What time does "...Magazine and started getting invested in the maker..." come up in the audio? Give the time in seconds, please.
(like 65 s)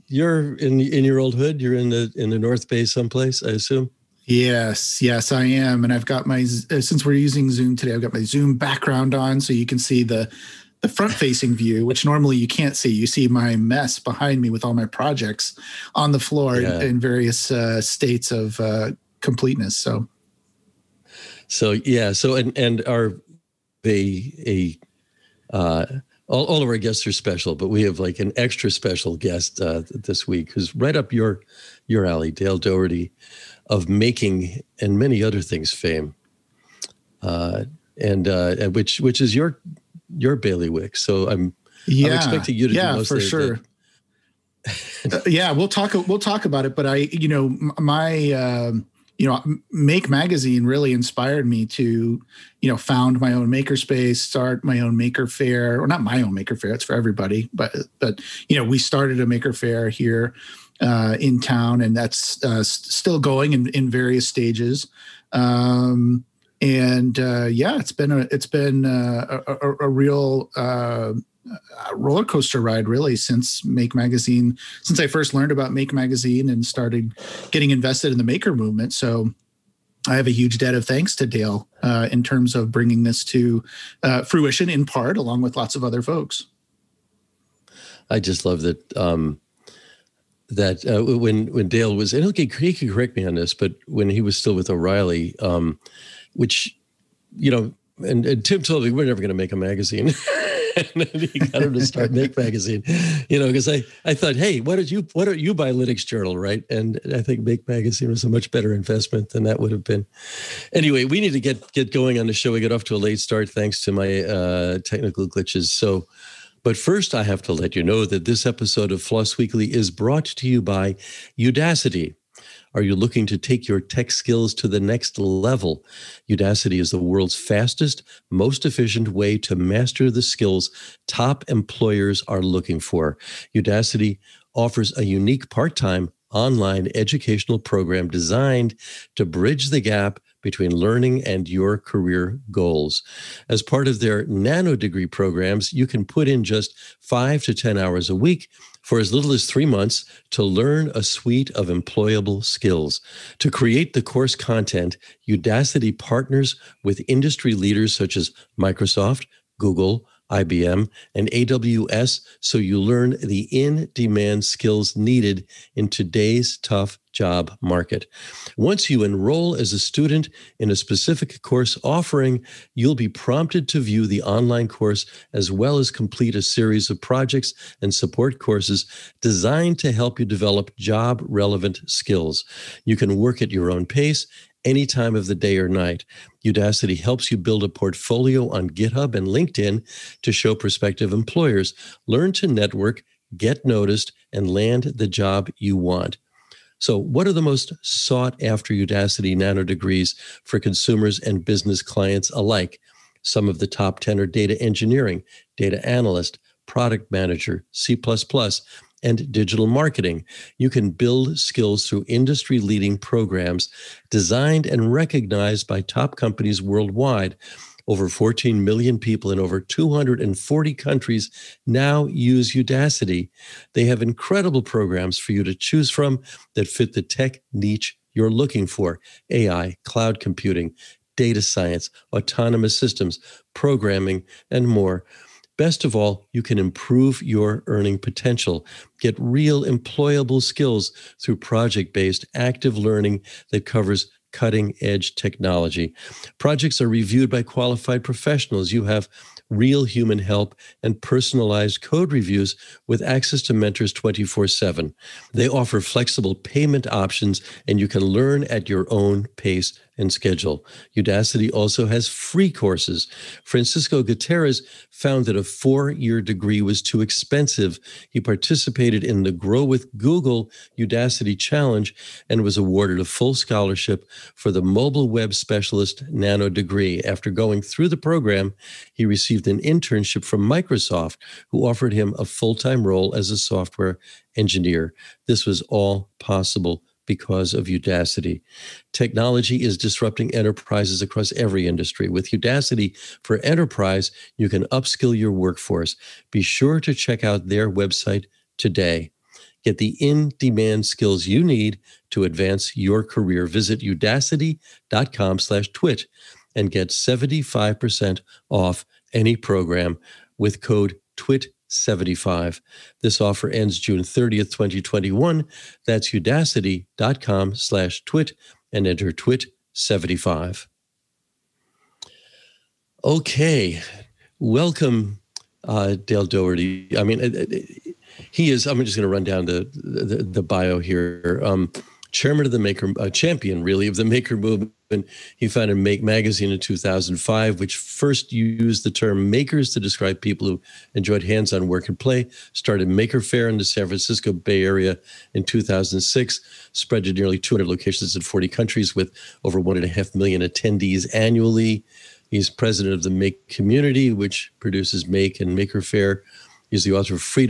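75 s.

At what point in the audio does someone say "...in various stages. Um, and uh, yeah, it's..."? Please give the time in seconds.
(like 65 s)
63 s.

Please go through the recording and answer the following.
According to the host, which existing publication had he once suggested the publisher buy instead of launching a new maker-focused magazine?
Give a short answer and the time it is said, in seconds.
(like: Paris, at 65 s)
Linux Journal, at 105 s.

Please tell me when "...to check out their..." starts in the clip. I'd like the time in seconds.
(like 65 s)
296 s.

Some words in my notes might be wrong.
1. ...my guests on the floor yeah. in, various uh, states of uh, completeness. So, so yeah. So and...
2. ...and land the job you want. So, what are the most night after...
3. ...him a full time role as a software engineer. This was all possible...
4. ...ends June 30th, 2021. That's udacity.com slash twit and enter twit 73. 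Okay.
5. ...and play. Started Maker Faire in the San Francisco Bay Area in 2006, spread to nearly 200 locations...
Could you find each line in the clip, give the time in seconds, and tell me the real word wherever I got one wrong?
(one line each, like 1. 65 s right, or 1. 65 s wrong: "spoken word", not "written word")
1. 14 s wrong: "projects", not "guests"
2. 194 s wrong: "sought", not "night"
3. 281 s right
4. 313 s wrong: "75", not "73"
5. 341 s right.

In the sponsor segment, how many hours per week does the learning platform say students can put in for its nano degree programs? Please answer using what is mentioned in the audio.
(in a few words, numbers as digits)
5 to 10.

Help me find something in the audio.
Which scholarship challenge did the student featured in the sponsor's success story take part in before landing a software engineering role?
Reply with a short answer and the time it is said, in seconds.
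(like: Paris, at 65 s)
Grow with Google Udacity Challenge, at 269 s.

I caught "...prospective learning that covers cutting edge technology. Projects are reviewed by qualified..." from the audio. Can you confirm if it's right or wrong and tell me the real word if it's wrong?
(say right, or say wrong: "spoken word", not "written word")
wrong: "active", not "prospective".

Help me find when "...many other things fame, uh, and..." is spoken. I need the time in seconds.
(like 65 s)
34 s.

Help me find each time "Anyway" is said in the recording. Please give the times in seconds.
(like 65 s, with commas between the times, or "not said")
110 s.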